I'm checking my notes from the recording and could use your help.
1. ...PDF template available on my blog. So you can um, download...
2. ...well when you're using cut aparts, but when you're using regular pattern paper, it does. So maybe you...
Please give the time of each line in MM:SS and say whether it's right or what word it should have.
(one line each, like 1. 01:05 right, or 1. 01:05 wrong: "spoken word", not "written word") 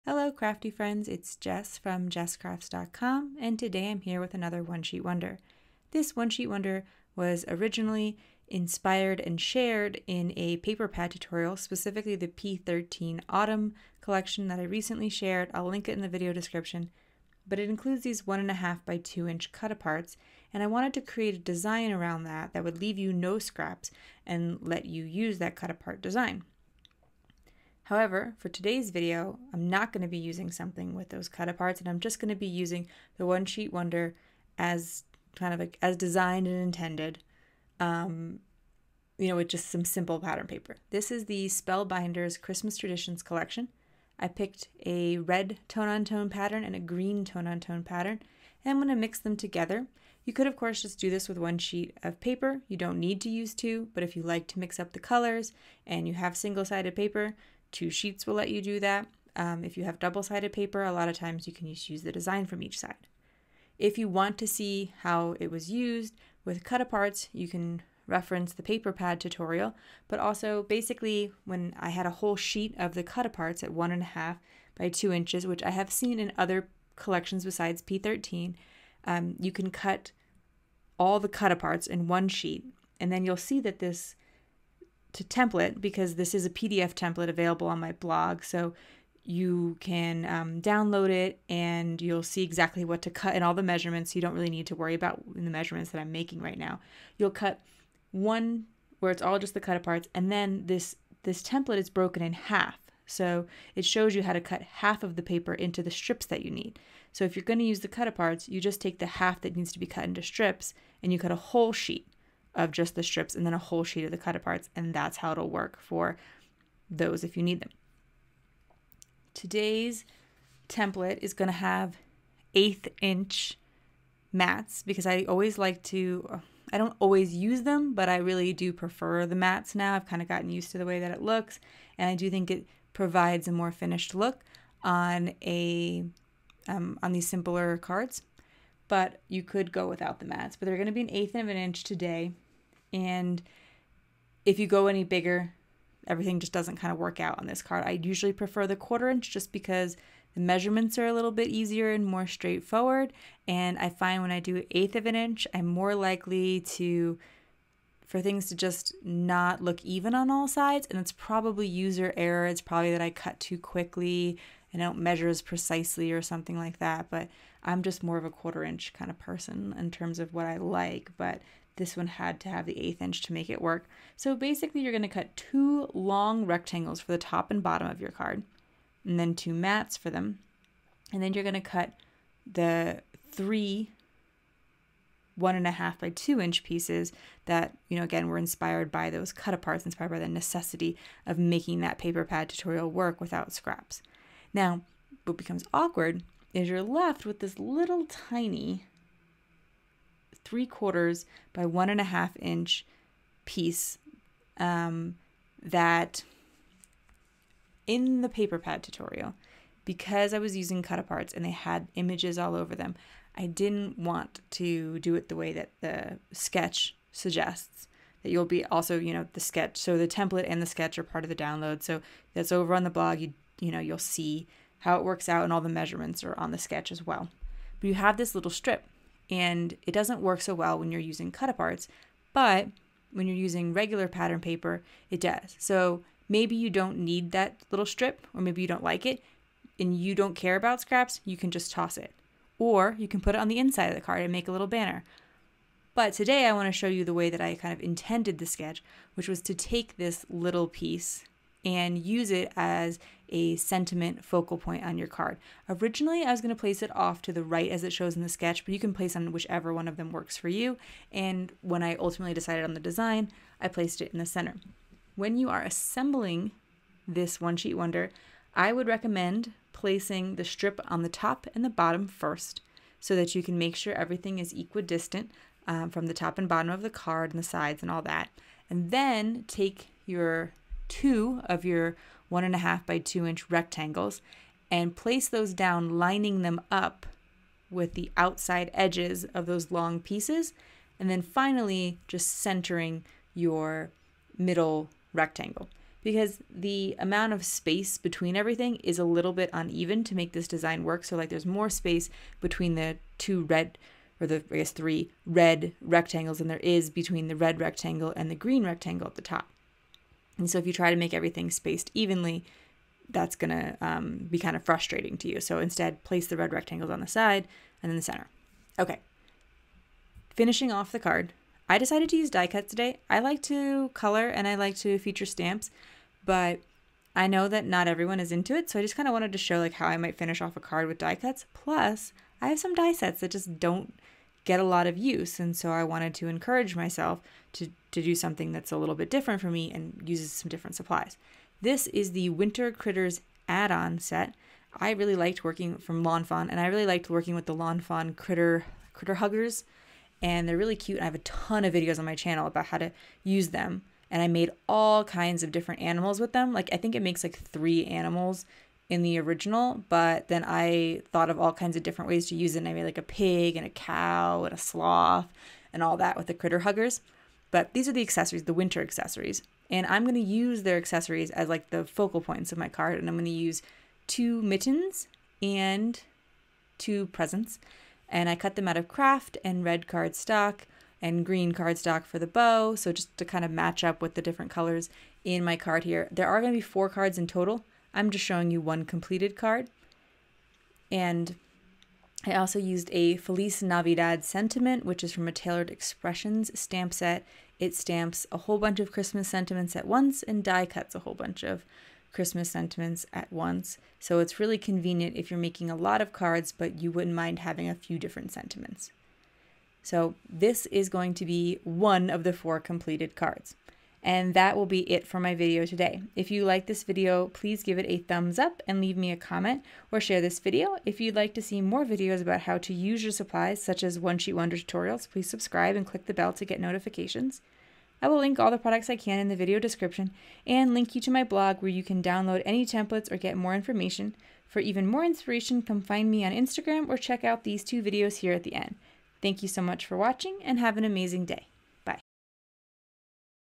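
1. 01:26 right
2. 03:50 right.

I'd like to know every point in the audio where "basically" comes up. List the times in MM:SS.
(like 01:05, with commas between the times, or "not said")
01:10, 02:54.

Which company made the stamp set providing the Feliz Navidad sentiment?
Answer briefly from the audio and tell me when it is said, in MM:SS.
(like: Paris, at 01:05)
Taylored Expressions, at 06:35.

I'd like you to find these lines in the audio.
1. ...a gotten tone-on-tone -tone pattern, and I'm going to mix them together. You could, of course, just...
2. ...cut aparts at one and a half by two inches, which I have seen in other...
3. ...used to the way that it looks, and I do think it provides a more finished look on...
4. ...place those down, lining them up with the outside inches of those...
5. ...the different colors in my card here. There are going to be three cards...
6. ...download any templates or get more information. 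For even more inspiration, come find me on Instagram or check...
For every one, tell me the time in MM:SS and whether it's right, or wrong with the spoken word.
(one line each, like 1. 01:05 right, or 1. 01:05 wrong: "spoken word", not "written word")
1. 00:46 wrong: "green", not "gotten"
2. 01:13 right
3. 02:10 right
4. 04:44 wrong: "edges", not "inches"
5. 06:24 wrong: "four", not "three"
6. 07:12 right.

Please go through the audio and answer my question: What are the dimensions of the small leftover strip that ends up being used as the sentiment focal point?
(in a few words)
3/4 by 1 1/2 inch.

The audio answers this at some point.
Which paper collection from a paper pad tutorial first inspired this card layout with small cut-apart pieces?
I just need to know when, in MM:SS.
00:12.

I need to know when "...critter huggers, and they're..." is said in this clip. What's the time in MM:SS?
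05:48.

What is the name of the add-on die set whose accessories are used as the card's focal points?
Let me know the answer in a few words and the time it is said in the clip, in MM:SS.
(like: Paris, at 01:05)
Winter Critters, at 05:42.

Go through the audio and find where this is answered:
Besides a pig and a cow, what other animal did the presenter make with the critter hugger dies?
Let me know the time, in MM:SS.
06:04.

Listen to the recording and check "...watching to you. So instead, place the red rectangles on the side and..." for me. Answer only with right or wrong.
wrong.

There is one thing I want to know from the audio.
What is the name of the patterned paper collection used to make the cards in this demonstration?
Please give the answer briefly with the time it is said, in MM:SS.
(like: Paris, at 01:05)
Spellbinders Christmas Traditions, at 00:41.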